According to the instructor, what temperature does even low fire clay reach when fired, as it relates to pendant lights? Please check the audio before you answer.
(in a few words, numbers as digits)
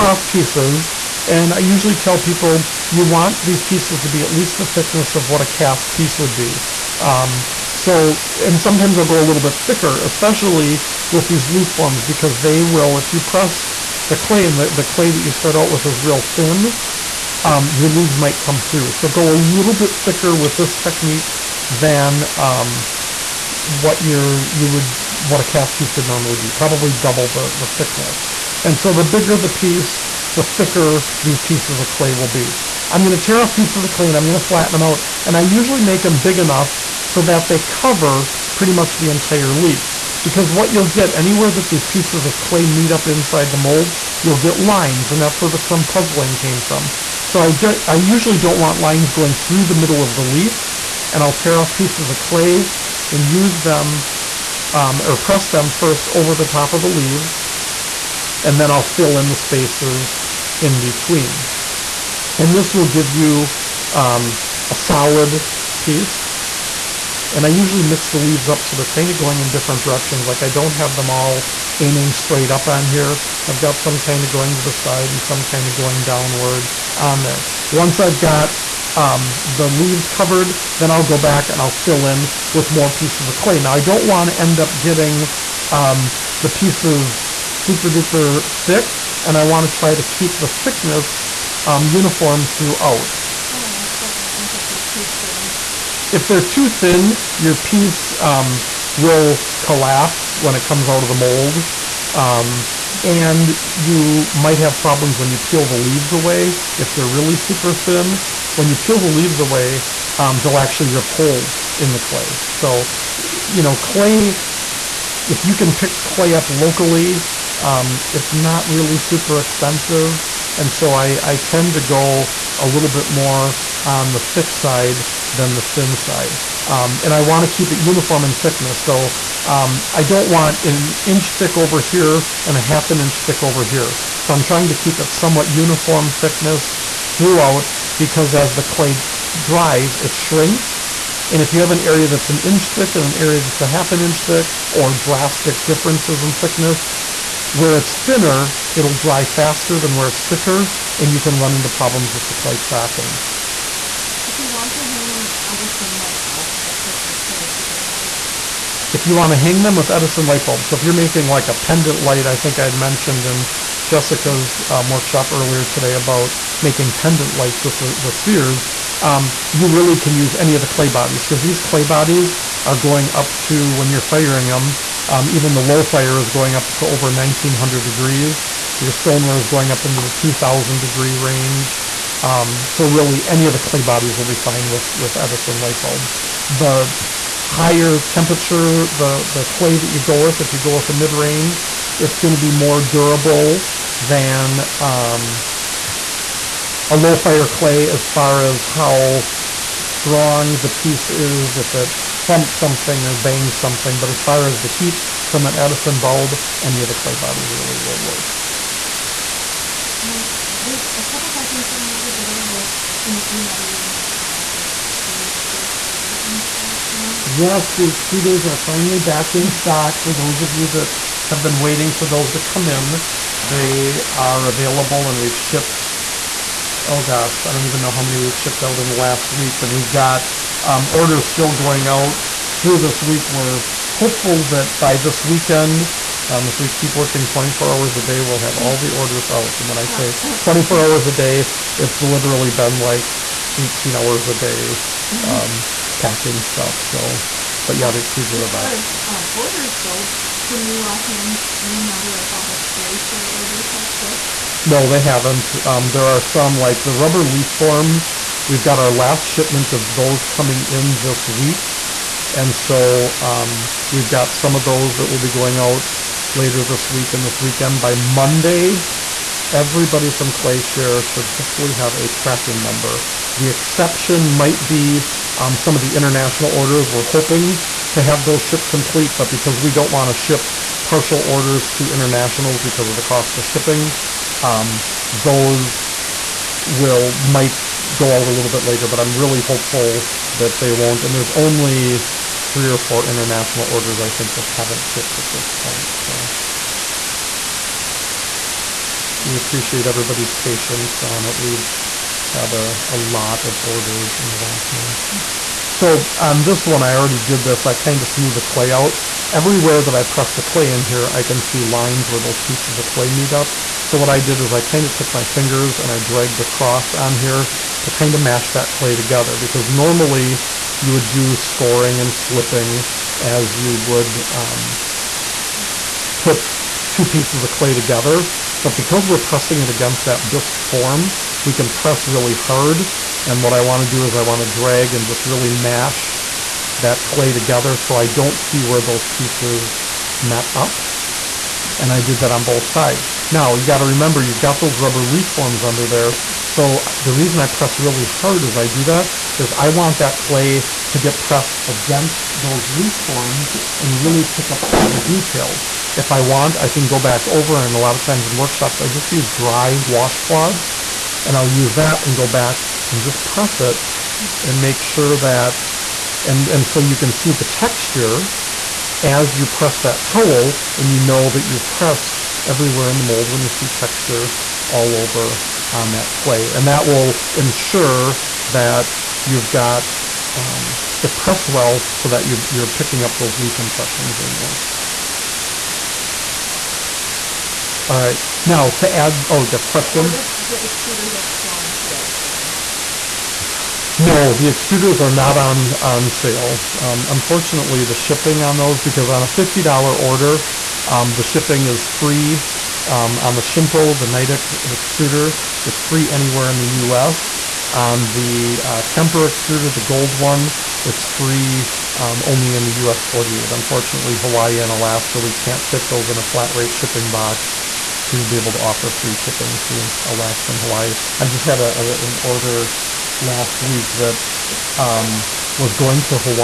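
over 1900 degrees.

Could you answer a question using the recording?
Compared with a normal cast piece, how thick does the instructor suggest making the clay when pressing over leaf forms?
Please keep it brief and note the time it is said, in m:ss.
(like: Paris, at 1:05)
double, at 0:26.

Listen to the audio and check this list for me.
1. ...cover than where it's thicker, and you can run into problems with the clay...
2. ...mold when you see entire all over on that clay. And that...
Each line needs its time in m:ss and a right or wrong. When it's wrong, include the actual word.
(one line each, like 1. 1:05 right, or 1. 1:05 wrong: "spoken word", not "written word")
1. 2:29 wrong: "faster", not "cover"
2. 6:13 wrong: "texture", not "entire".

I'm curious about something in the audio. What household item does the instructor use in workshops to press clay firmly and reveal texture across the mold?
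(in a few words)
dry washcloths.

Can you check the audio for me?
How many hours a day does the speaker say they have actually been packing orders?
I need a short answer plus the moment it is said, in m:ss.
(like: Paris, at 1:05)
18, at 4:03.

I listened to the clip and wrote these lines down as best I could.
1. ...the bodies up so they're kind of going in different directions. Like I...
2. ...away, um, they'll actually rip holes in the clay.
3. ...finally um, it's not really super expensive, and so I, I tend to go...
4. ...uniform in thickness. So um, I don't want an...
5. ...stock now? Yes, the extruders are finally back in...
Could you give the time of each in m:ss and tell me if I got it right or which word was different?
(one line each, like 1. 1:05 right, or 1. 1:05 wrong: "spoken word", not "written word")
1. 1:08 wrong: "leaves", not "bodies"
2. 1:49 right
3. 1:56 wrong: "locally", not "finally"
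4. 2:07 right
5. 3:36 right.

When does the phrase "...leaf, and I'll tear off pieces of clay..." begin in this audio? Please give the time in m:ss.
0:50.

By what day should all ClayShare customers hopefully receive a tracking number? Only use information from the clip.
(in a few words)
Monday.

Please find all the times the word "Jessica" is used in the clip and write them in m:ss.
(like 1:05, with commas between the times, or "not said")
2:43.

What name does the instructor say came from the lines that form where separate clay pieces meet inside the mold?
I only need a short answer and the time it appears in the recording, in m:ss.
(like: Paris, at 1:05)
puzzling, at 0:45.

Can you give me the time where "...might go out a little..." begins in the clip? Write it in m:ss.
4:47.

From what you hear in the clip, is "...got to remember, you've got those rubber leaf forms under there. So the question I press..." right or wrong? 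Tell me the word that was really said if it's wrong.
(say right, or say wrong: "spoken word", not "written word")
wrong: "reason", not "question".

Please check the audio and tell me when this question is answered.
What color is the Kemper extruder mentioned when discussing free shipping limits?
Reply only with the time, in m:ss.
6:49.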